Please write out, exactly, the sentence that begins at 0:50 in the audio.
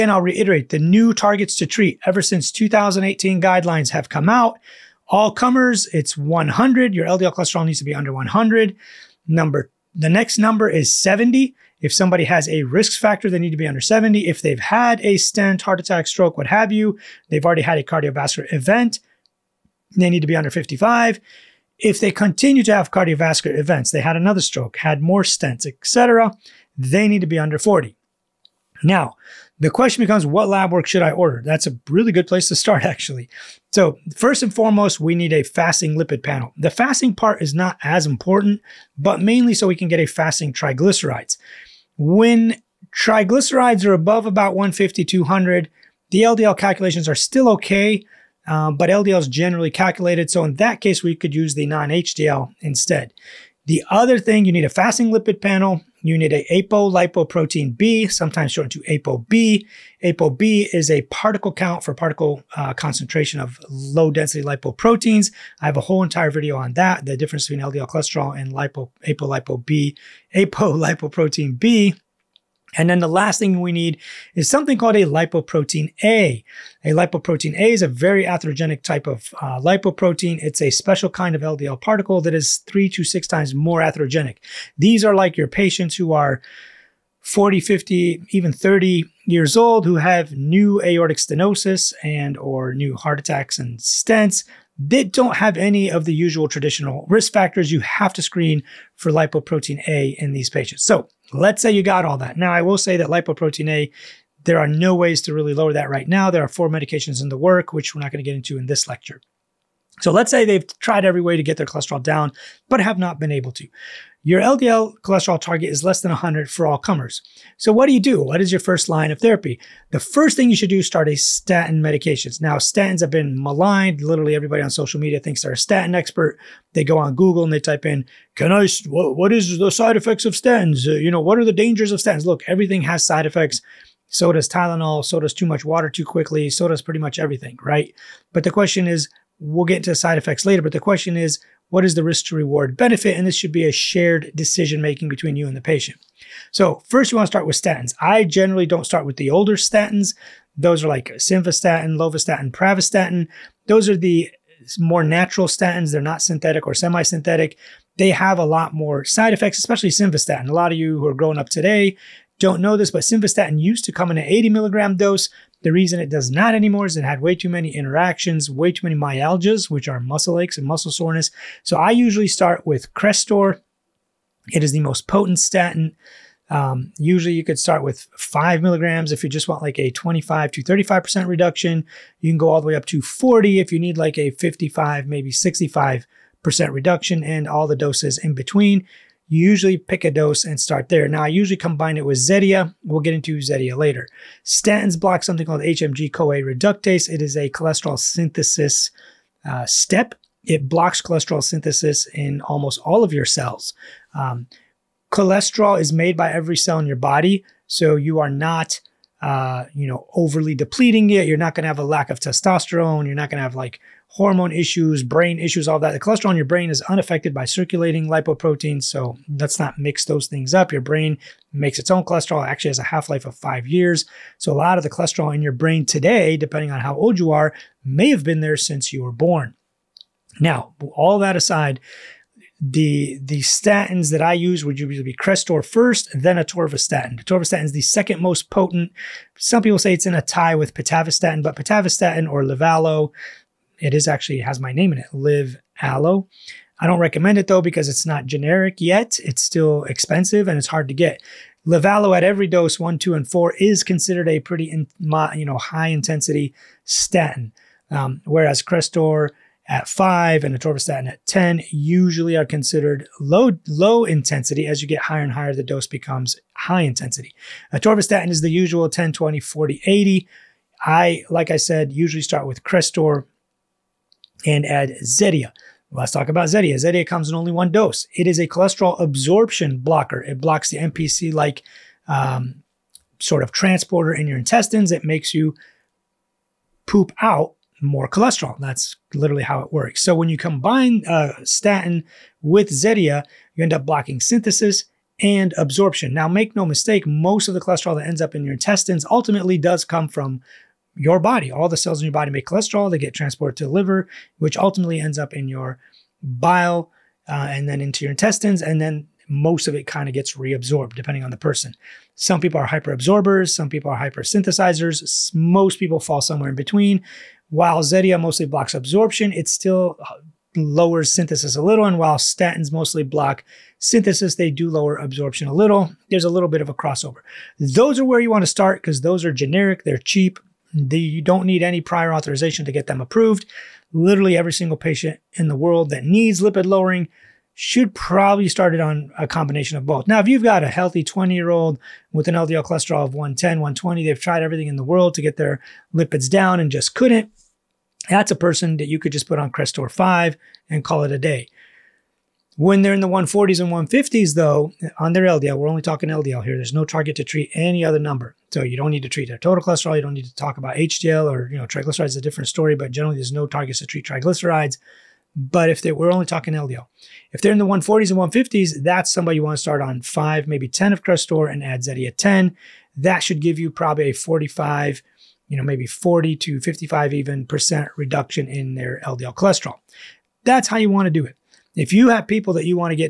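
So in that case, we could use the non-HDL instead.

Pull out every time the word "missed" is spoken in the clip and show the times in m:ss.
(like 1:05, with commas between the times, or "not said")
not said.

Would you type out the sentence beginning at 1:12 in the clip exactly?
And then the last thing we need is something called a lipoprotein A.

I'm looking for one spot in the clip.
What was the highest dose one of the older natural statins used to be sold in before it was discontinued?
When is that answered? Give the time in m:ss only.
2:44.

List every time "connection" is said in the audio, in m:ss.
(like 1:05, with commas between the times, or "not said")
not said.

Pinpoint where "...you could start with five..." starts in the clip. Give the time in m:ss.
2:57.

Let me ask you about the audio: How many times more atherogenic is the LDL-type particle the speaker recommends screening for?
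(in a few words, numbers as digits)
3 to 6 times.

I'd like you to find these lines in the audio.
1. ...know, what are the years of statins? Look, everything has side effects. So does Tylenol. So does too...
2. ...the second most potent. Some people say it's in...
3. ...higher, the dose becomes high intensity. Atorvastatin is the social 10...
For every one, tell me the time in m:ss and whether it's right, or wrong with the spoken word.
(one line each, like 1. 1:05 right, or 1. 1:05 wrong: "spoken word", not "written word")
1. 2:11 wrong: "dangers", not "years"
2. 3:57 right
3. 4:25 wrong: "usual", not "social".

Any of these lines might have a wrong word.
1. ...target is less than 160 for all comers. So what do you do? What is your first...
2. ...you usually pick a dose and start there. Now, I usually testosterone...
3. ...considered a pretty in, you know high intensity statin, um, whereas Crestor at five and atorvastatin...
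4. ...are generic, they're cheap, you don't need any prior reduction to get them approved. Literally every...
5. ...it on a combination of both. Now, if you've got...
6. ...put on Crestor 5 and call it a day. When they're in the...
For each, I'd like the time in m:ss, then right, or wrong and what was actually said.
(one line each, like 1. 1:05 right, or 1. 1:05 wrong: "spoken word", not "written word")
1. 1:55 wrong: "100", not "160"
2. 3:09 wrong: "combine", not "testosterone"
3. 4:13 right
4. 5:29 wrong: "authorization", not "reduction"
5. 5:38 right
6. 5:49 right.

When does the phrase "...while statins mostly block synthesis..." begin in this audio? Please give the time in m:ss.
5:21.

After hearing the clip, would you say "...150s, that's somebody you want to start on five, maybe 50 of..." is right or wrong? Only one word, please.
wrong.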